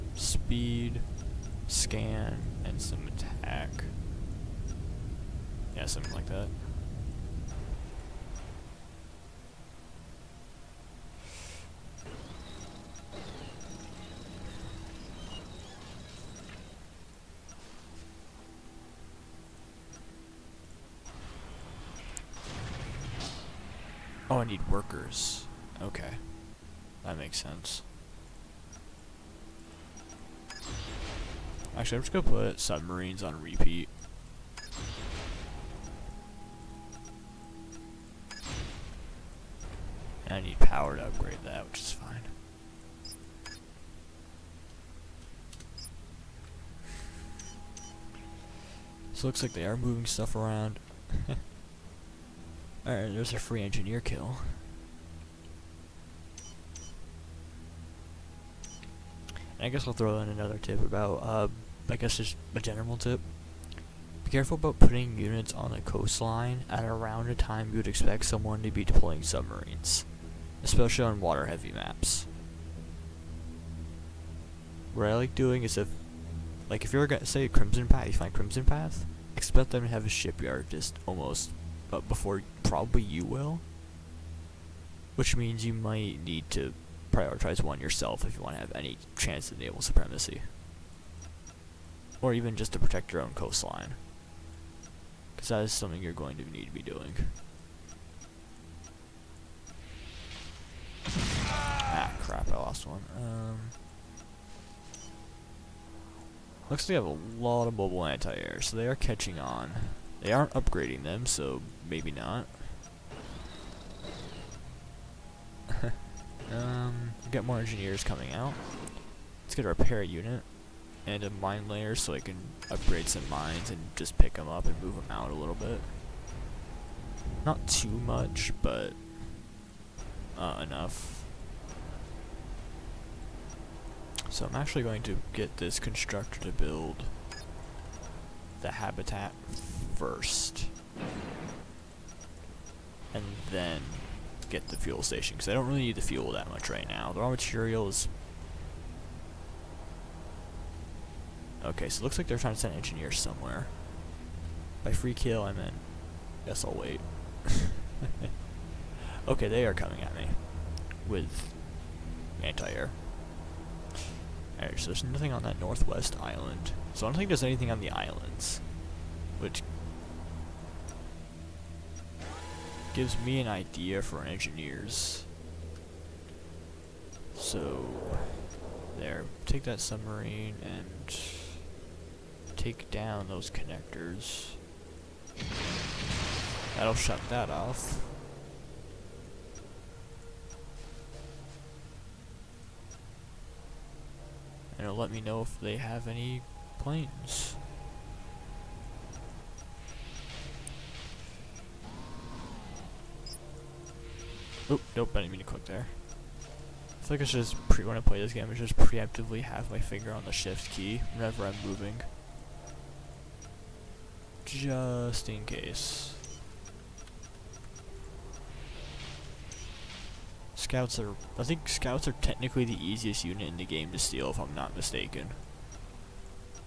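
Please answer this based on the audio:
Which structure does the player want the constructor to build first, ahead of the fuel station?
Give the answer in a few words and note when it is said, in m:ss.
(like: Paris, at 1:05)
Habitat, at 2:18.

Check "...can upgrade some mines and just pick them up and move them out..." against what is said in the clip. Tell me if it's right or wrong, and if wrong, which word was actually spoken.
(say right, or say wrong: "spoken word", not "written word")
right.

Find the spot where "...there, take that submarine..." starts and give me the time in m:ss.
2:58.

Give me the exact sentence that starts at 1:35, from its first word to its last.
Because that is something you're going to need to be doing.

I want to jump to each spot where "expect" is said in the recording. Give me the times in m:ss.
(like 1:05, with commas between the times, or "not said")
1:07, 1:19.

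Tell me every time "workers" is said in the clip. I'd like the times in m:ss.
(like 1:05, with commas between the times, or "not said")
0:24.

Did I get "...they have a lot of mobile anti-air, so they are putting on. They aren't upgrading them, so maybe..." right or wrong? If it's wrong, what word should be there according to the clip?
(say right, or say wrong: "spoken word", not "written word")
wrong: "catching", not "putting".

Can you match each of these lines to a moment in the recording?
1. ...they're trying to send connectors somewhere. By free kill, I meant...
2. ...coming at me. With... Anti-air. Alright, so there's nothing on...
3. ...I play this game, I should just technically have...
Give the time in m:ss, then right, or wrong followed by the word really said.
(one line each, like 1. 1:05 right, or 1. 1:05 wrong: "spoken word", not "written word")
1. 2:32 wrong: "engineers", not "connectors"
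2. 2:39 right
3. 3:27 wrong: "preemptively", not "technically".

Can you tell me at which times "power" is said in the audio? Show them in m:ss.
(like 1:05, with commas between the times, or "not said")
0:40.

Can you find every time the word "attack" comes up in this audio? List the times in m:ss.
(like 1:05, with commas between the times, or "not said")
0:03.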